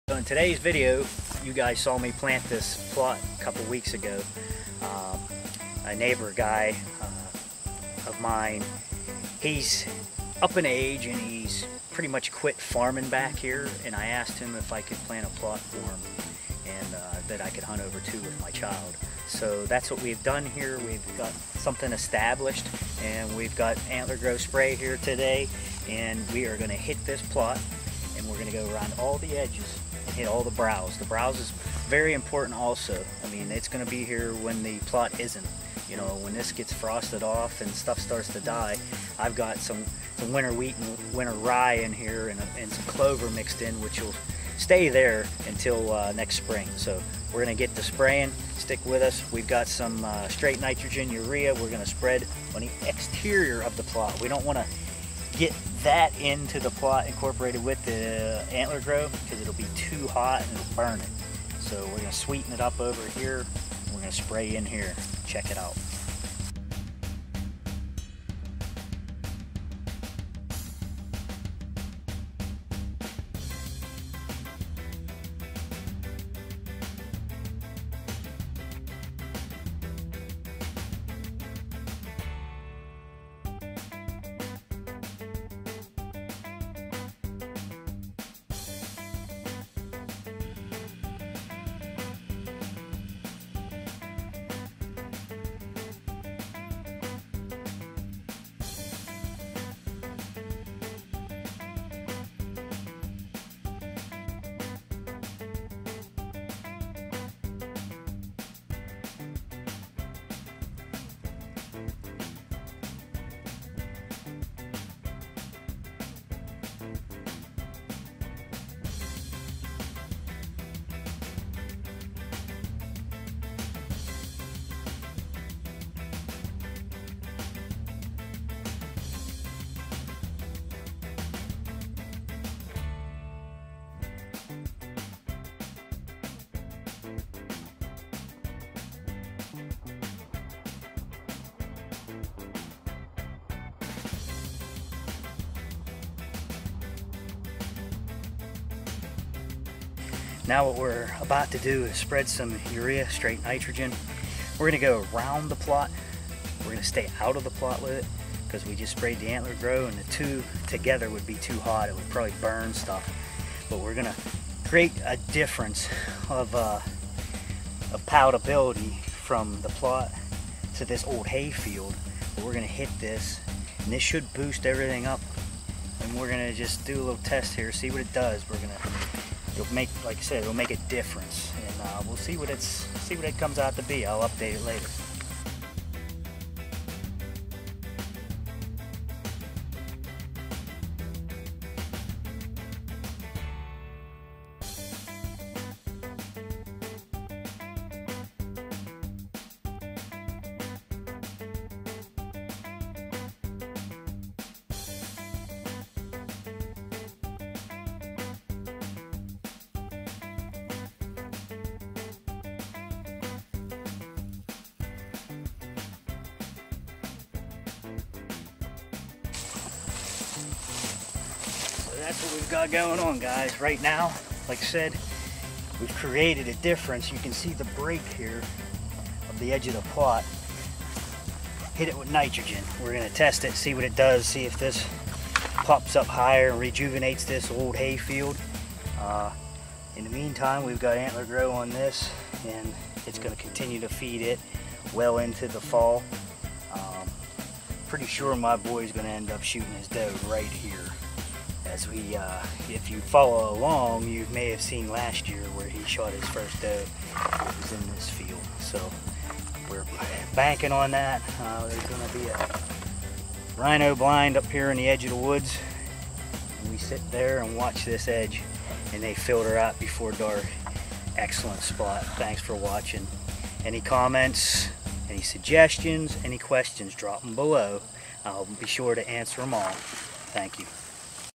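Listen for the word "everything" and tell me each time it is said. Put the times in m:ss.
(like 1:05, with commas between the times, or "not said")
2:54.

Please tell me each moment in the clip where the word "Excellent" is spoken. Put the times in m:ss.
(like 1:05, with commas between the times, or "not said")
4:31.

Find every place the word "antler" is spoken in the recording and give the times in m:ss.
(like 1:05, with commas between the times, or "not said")
0:23, 0:58, 2:39, 4:00.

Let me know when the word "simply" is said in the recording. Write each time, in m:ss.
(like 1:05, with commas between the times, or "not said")
not said.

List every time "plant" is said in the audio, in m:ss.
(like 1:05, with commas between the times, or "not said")
0:02, 0:15.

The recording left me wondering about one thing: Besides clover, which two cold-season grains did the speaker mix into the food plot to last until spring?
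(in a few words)
winter wheat and winter rye.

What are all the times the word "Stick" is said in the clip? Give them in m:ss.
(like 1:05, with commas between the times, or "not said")
0:48.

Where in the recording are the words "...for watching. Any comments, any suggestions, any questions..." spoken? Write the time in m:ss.
4:32.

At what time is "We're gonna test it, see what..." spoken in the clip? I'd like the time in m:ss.
3:52.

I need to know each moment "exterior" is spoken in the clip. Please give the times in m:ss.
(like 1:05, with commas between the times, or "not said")
0:52.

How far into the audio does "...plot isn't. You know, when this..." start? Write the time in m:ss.
0:34.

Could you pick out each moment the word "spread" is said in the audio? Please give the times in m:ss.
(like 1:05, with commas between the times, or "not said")
0:51, 2:31.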